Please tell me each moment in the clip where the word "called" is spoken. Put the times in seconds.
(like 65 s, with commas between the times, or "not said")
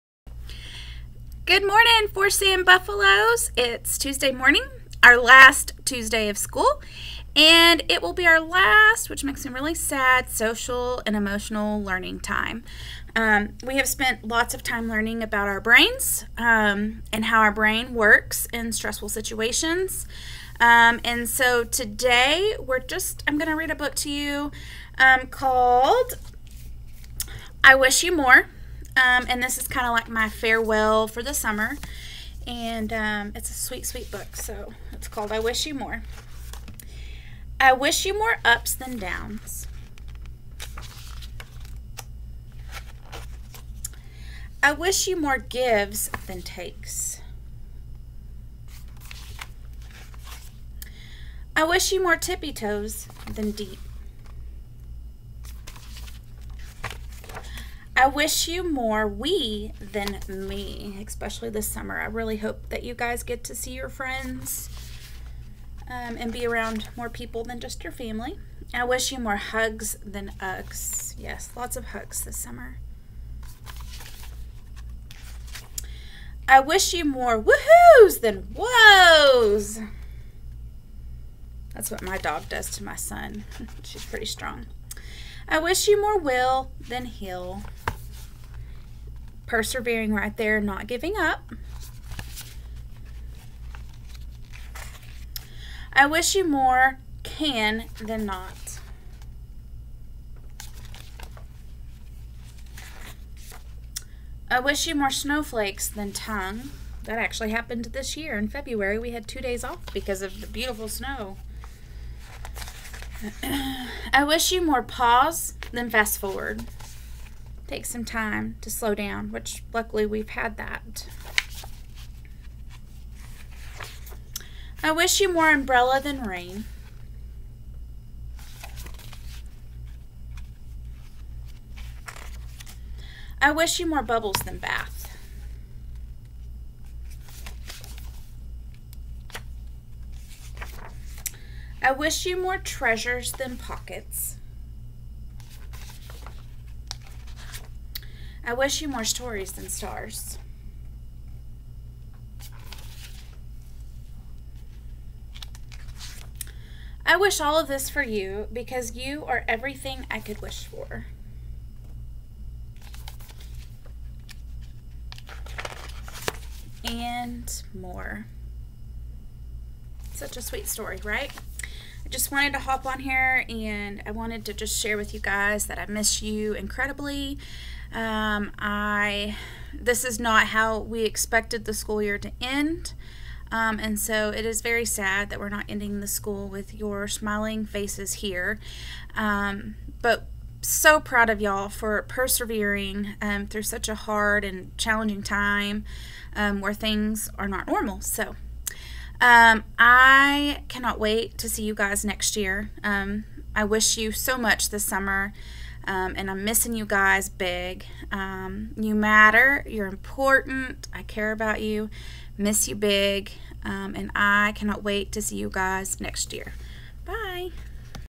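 25 s, 35 s.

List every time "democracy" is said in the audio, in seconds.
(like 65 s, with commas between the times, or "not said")
not said.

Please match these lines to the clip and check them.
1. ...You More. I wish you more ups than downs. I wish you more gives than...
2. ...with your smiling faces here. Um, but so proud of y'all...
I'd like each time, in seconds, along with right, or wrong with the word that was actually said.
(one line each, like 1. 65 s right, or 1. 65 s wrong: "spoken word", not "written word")
1. 35 s right
2. 186 s right.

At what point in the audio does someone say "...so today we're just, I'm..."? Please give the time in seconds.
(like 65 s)
21 s.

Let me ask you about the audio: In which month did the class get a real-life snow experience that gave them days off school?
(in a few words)
February.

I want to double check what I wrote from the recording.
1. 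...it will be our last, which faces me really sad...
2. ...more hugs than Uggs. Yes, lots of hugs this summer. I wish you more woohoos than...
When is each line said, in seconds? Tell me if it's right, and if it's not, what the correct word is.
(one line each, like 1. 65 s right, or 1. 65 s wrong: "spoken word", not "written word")
1. 7 s wrong: "makes", not "faces"
2. 69 s right.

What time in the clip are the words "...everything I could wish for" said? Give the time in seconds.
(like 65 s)
159 s.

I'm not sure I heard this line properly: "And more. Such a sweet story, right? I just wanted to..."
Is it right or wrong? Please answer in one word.
right.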